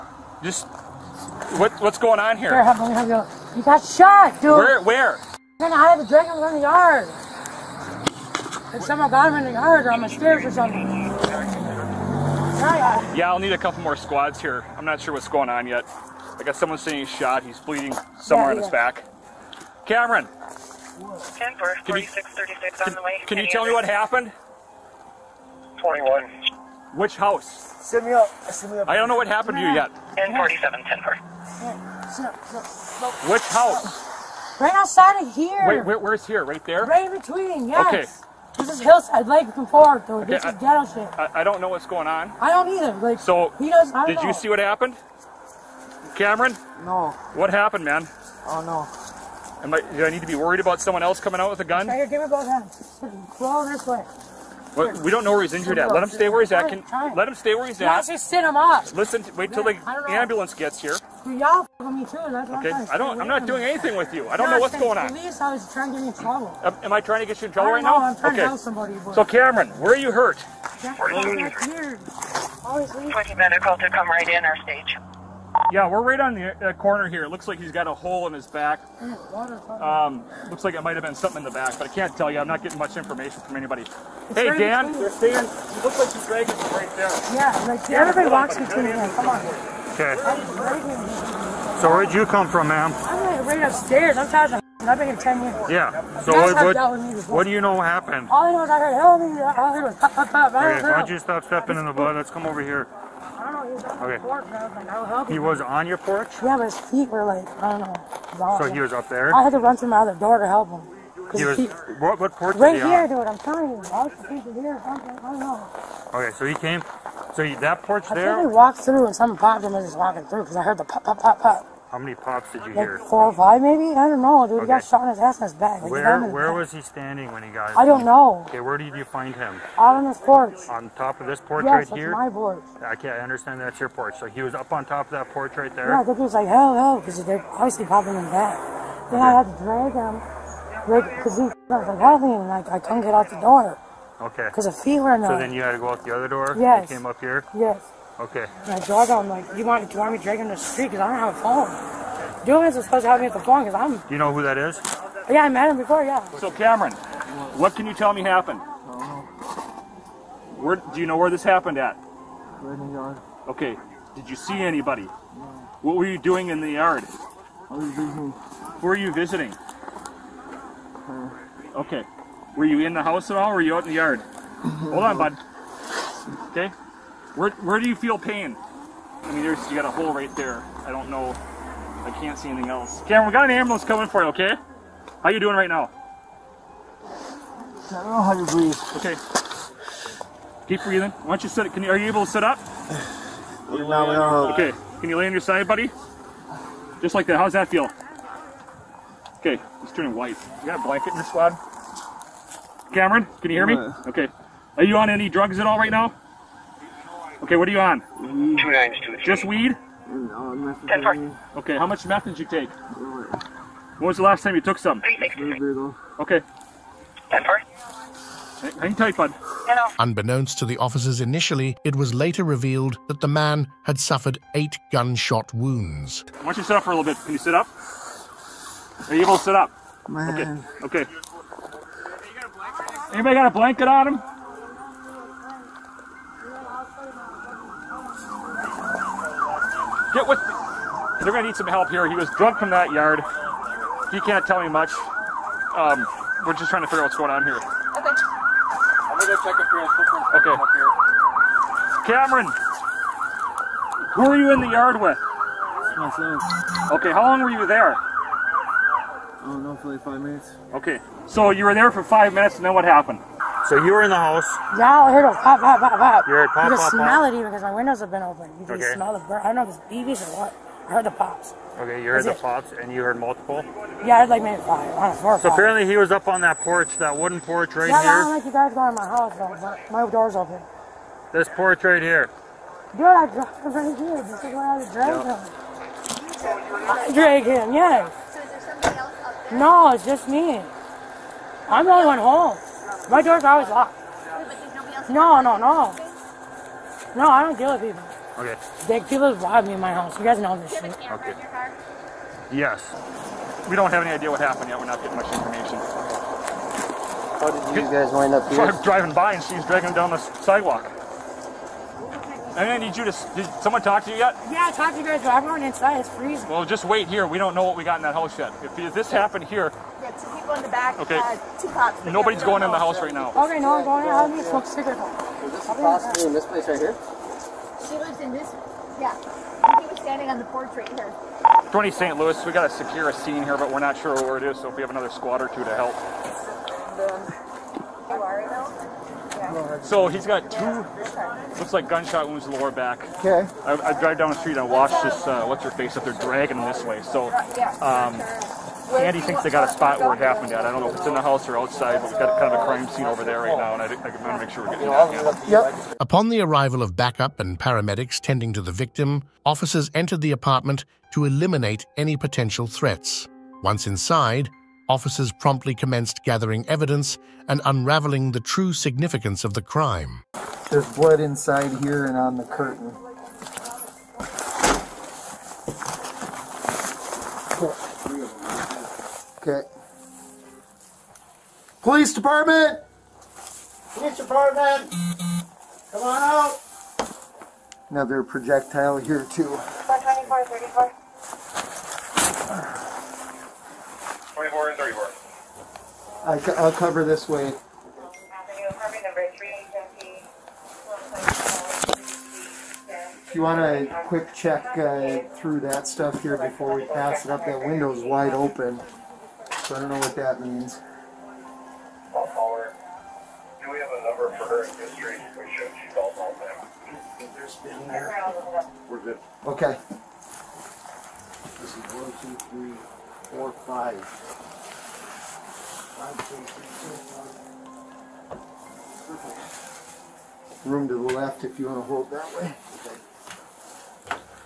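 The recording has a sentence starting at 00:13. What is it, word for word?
Yeah, I'll need a couple more squads here.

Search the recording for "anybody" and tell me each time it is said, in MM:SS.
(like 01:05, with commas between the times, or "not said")
01:23, 02:44, 03:53.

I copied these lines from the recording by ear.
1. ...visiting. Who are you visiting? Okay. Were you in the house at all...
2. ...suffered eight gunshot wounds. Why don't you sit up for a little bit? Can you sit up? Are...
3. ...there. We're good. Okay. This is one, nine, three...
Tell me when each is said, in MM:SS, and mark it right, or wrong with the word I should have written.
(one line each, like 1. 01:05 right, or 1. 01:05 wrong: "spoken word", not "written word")
1. 02:47 right
2. 03:43 right
3. 06:57 wrong: "two", not "nine".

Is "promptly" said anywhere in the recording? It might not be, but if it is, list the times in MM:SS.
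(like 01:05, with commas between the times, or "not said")
06:05.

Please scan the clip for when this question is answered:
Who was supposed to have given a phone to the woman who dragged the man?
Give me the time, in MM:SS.
02:32.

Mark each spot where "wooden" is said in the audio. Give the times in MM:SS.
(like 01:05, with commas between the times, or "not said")
04:37.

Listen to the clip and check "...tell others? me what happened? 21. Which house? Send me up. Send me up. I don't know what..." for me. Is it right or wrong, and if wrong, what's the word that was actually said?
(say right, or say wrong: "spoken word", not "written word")
right.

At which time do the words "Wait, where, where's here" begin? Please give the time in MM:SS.
00:35.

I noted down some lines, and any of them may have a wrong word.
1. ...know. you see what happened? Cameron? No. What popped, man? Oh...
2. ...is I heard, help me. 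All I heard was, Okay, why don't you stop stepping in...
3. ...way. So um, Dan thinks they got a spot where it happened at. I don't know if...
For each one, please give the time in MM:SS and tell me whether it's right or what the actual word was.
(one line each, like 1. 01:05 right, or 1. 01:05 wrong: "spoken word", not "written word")
1. 00:44 wrong: "happened", not "popped"
2. 01:38 right
3. 05:46 wrong: "Andy", not "Dan".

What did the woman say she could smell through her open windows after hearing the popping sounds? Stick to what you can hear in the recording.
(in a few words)
the burn.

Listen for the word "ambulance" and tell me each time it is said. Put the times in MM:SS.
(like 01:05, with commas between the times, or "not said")
01:00, 03:03.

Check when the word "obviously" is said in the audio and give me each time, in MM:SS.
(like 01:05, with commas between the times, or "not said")
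02:17.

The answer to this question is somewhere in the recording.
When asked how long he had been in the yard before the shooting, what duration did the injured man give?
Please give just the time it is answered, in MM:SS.
04:19.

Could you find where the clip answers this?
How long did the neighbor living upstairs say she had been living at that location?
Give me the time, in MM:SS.
01:34.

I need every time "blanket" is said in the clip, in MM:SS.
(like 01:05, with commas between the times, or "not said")
03:20, 03:53.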